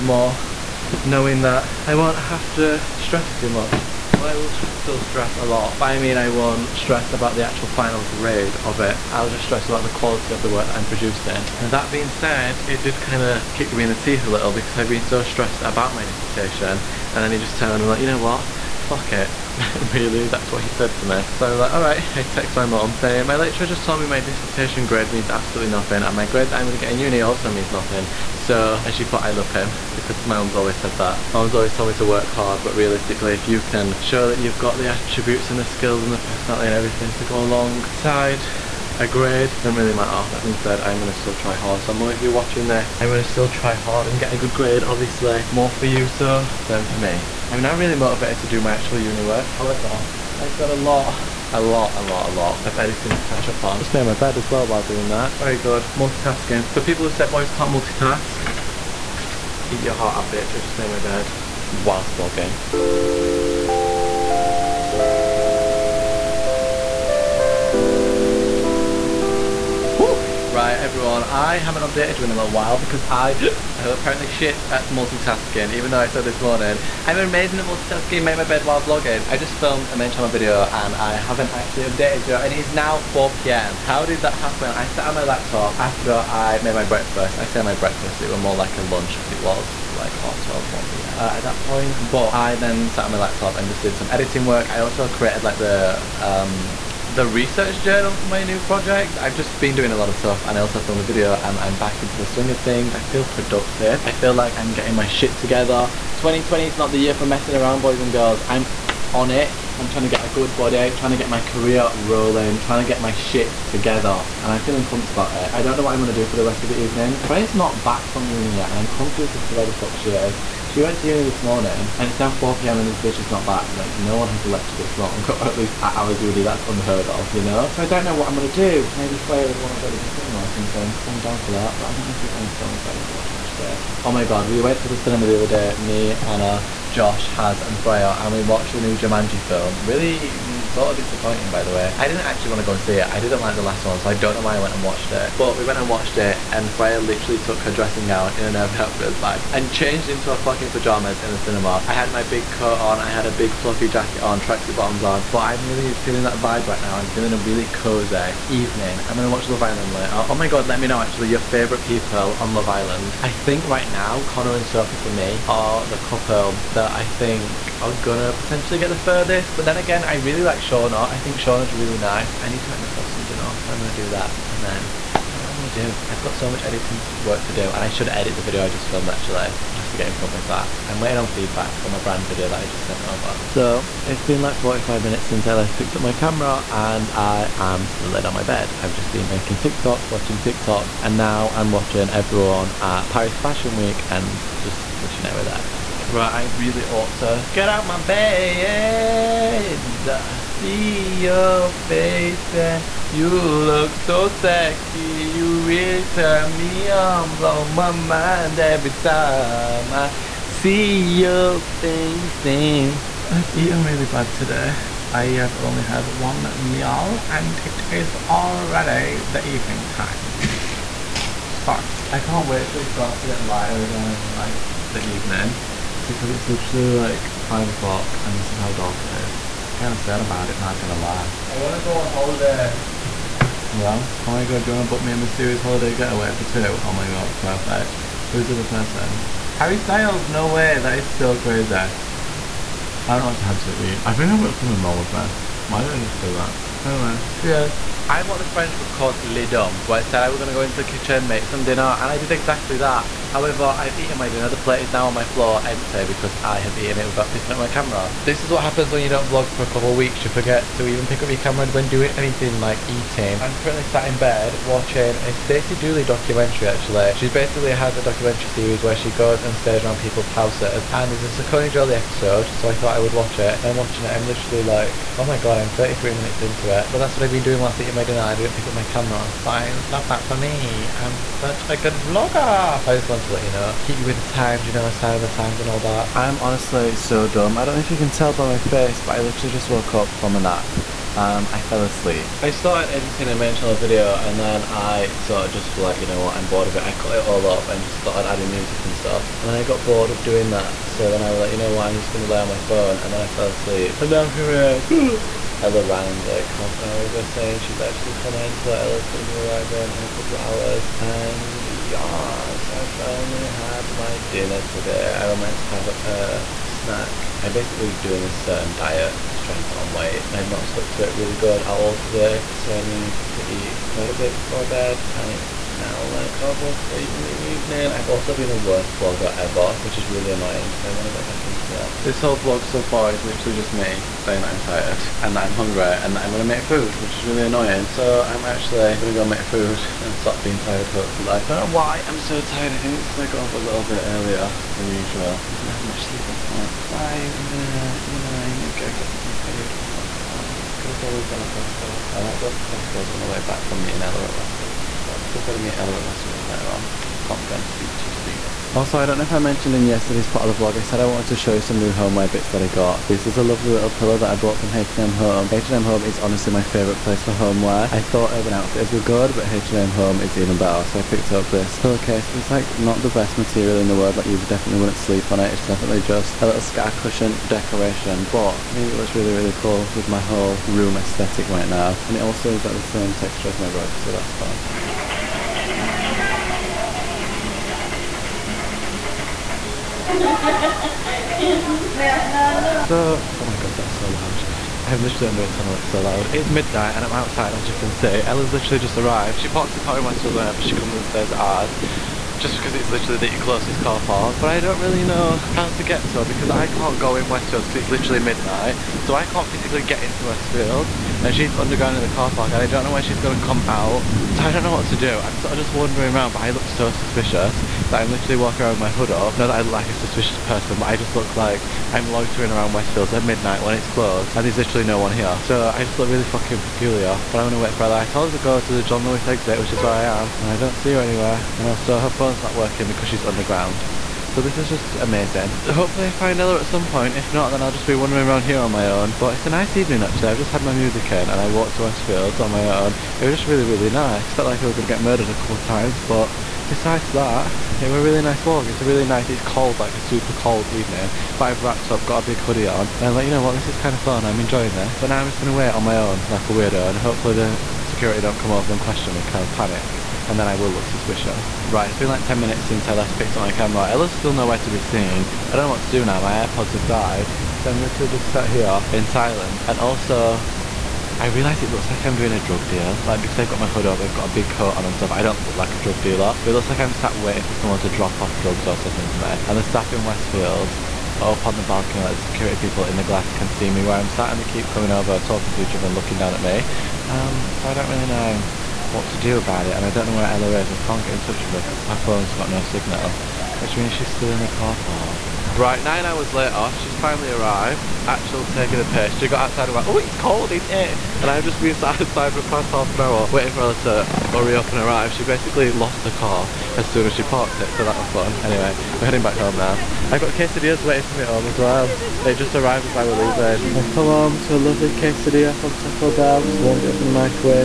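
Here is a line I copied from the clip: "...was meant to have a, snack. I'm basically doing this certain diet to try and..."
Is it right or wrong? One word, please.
right.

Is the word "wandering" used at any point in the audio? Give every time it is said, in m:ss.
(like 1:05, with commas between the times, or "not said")
6:55, 7:17.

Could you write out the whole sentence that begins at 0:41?
So mum, if you're watching this, I'm gonna still try hard and get a good grade, obviously.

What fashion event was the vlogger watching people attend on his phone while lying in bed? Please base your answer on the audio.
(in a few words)
Paris Fashion Week.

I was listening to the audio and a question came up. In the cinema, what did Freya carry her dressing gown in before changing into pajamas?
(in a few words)
An Urban Outfitters bag.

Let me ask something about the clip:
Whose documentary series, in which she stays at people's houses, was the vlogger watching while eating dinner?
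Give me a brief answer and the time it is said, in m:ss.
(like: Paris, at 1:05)
Stacey Dooley, at 4:25.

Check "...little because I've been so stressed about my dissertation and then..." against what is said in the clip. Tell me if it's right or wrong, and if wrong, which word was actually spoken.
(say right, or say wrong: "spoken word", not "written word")
right.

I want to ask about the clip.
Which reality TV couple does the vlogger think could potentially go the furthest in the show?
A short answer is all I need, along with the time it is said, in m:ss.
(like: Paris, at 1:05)
Connor and Sophie, at 2:44.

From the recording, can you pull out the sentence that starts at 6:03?
This is a lovely little pillow that I bought from H&M Home.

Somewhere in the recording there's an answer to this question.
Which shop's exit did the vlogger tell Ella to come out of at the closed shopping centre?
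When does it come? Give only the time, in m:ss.
7:08.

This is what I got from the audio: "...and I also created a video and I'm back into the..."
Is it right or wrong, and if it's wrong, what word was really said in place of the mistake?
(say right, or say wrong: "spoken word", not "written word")
wrong: "filmed", not "created".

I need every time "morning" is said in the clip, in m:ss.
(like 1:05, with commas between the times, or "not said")
1:16, 2:01.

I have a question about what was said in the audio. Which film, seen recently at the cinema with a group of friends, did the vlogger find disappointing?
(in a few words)
Jumanji.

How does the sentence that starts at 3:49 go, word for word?
Kinda sad about it, not gonna lie.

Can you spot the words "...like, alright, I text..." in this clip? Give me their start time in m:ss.
0:21.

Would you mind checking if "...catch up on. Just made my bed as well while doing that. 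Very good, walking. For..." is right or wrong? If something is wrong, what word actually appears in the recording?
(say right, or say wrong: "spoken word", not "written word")
wrong: "multitasking", not "walking".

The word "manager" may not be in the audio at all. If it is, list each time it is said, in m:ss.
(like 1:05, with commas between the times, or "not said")
not said.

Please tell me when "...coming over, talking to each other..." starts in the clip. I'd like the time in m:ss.
8:04.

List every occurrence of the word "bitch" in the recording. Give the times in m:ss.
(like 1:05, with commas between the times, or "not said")
1:00, 2:02.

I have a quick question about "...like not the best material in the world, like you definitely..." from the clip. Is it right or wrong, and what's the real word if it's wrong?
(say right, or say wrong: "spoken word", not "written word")
right.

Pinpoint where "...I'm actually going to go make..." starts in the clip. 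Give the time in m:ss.
5:38.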